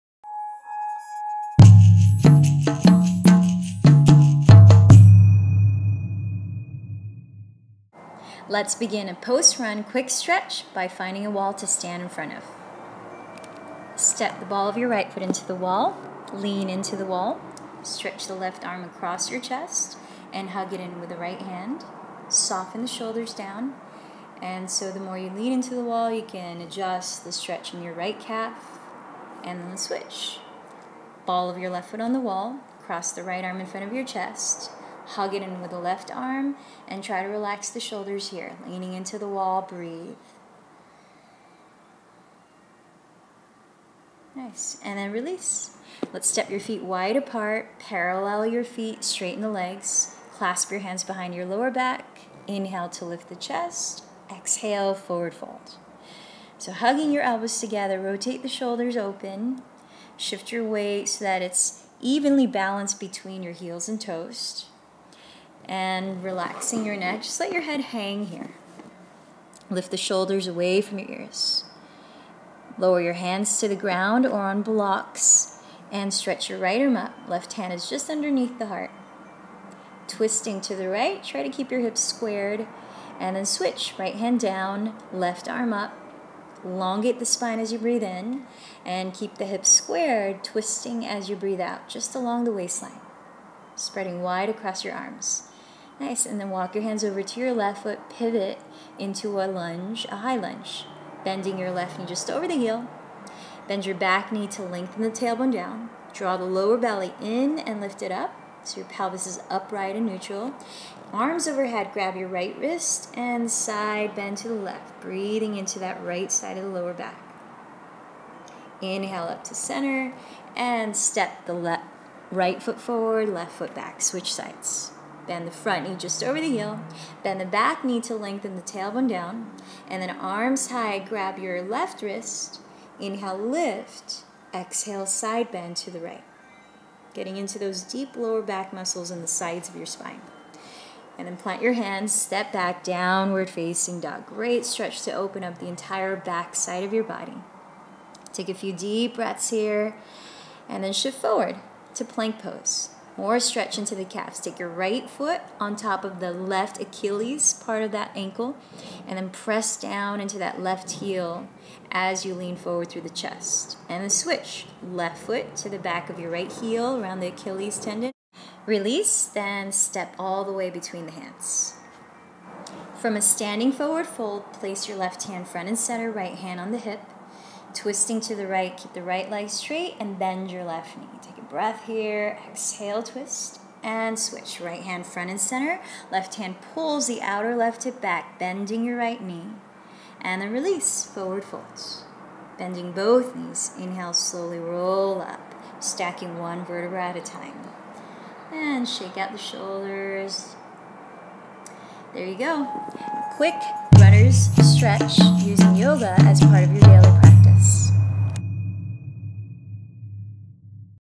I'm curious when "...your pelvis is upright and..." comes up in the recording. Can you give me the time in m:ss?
1:48.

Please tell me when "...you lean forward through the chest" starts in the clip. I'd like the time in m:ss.
2:42.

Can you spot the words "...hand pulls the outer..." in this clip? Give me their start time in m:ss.
3:06.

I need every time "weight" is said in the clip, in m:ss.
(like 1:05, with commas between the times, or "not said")
1:00.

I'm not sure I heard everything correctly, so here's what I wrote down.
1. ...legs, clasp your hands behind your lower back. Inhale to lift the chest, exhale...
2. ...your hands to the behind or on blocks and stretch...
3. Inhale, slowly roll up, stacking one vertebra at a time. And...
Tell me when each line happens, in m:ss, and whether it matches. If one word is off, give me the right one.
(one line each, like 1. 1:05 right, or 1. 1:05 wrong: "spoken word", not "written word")
1. 0:49 right
2. 1:13 wrong: "ground", not "behind"
3. 3:13 right.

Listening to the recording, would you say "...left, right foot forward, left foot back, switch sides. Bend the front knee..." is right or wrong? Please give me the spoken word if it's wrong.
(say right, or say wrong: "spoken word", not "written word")
right.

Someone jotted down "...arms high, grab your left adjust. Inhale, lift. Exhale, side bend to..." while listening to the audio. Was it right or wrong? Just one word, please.
wrong.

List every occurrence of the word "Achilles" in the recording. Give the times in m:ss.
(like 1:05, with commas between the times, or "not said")
2:36, 2:47.